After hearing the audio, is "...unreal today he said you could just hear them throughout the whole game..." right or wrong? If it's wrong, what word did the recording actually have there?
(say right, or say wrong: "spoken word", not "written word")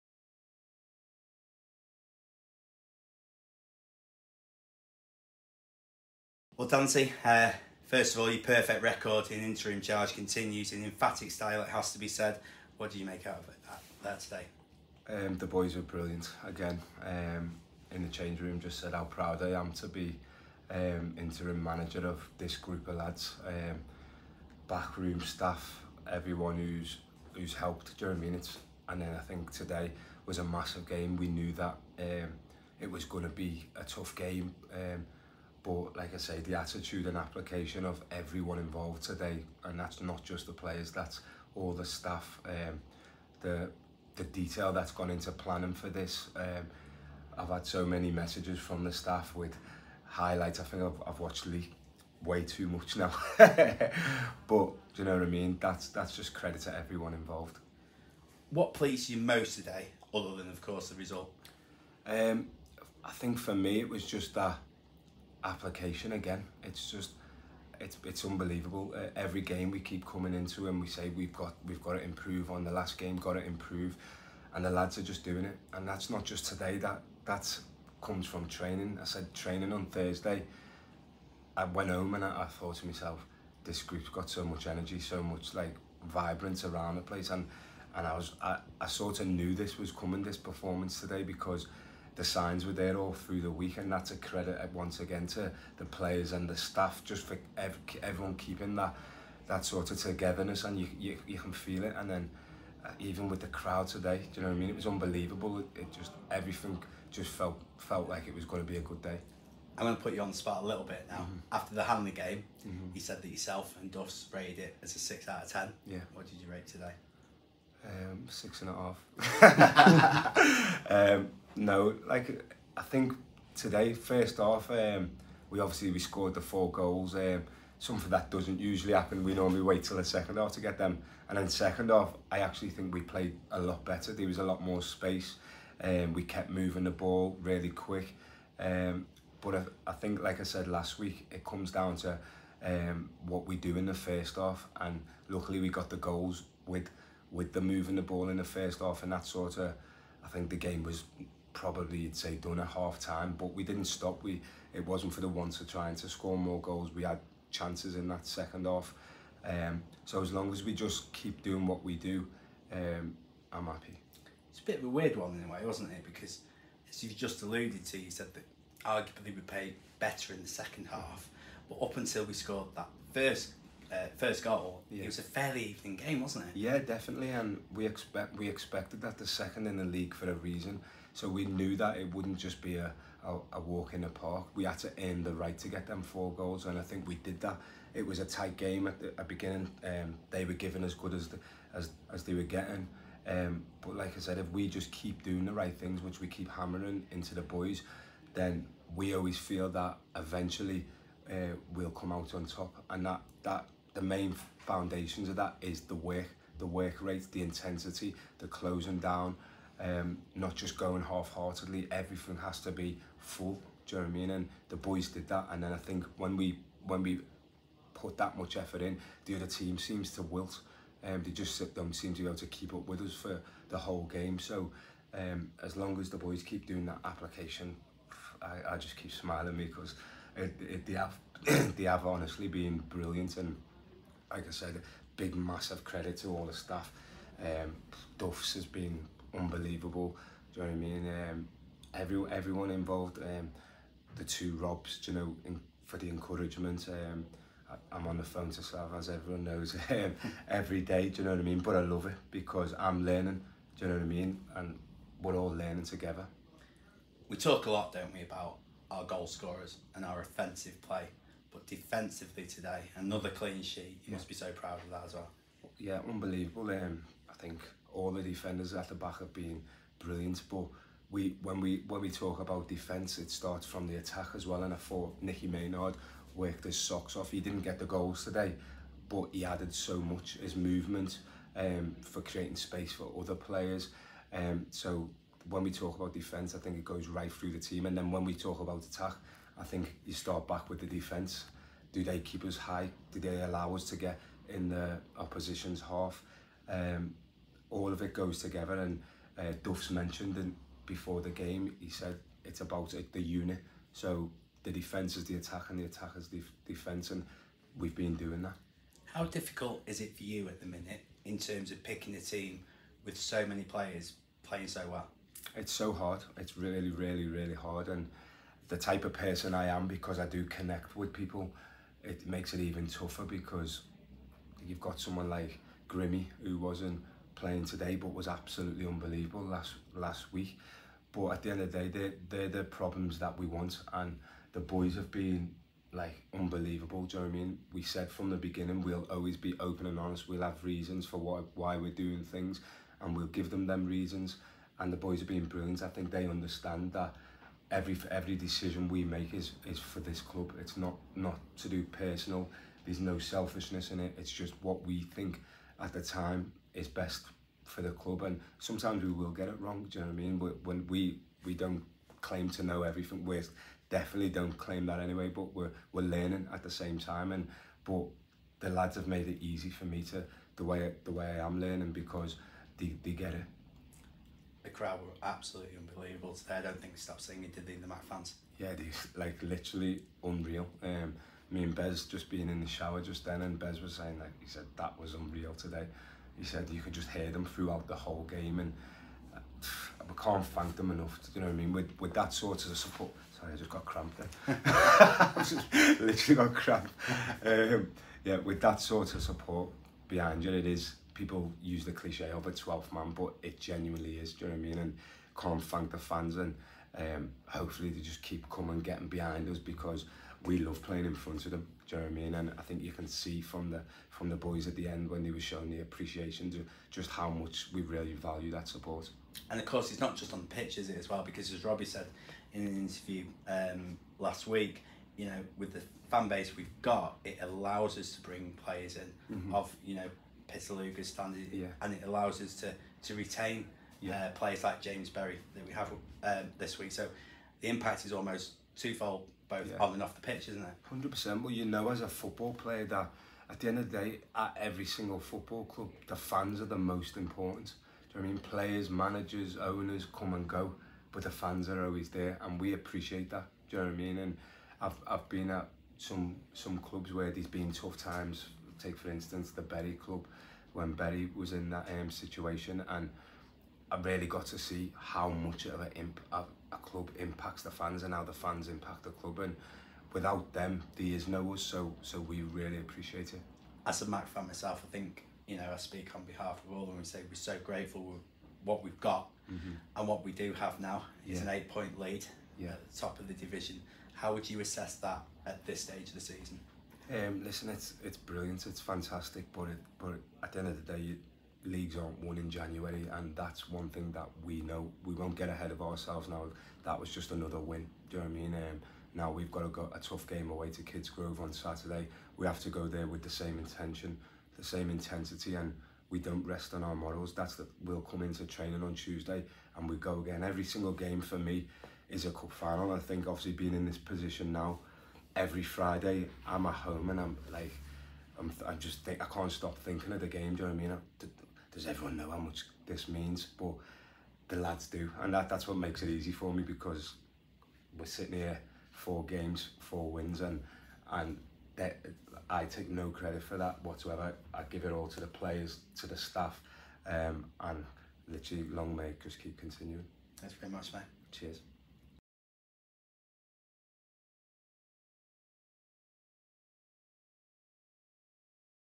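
right.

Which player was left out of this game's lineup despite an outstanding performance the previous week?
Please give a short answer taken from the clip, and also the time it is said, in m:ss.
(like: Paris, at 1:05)
Grimmy, at 5:25.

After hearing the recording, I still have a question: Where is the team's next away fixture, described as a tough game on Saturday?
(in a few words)
Kidsgrove.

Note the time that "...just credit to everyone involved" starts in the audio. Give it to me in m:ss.
0:56.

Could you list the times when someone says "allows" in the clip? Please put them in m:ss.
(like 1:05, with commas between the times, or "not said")
4:53, 7:07, 7:12.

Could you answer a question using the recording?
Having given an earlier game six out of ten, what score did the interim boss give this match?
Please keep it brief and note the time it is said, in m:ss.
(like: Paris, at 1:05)
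6.5, at 1:58.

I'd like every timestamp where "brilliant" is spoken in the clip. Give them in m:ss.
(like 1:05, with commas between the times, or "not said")
0:15, 3:52, 4:29, 5:45, 8:08.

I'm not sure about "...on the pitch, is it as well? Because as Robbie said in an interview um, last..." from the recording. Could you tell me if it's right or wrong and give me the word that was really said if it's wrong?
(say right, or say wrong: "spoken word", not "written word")
right.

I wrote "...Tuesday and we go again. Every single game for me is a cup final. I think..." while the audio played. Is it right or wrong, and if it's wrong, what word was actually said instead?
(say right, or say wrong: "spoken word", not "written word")
right.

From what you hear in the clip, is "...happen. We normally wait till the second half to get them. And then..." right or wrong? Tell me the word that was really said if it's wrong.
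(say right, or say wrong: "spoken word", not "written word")
right.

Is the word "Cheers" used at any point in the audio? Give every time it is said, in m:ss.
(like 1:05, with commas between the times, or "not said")
9:01.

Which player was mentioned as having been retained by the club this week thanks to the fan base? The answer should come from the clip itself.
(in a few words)
James Berry.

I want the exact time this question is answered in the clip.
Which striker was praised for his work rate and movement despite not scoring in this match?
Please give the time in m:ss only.
4:35.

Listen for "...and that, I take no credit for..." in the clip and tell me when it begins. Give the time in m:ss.
8:51.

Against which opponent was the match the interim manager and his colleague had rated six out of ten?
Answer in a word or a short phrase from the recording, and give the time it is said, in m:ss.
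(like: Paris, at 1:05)
Hanley, at 1:51.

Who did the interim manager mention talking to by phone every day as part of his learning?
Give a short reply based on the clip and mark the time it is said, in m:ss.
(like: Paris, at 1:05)
Slav, at 4:08.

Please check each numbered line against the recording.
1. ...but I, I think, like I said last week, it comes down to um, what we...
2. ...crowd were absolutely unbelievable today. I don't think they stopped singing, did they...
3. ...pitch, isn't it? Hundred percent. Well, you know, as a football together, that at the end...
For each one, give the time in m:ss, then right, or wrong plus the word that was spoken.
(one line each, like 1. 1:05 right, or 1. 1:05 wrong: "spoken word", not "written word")
1. 2:19 right
2. 6:14 right
3. 7:20 wrong: "player", not "together".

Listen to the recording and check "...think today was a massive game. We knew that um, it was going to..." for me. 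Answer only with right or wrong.
right.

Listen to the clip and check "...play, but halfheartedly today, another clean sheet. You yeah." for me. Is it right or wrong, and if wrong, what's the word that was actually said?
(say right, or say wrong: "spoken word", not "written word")
wrong: "defensively", not "halfheartedly".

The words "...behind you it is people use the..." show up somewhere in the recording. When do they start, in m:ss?
6:40.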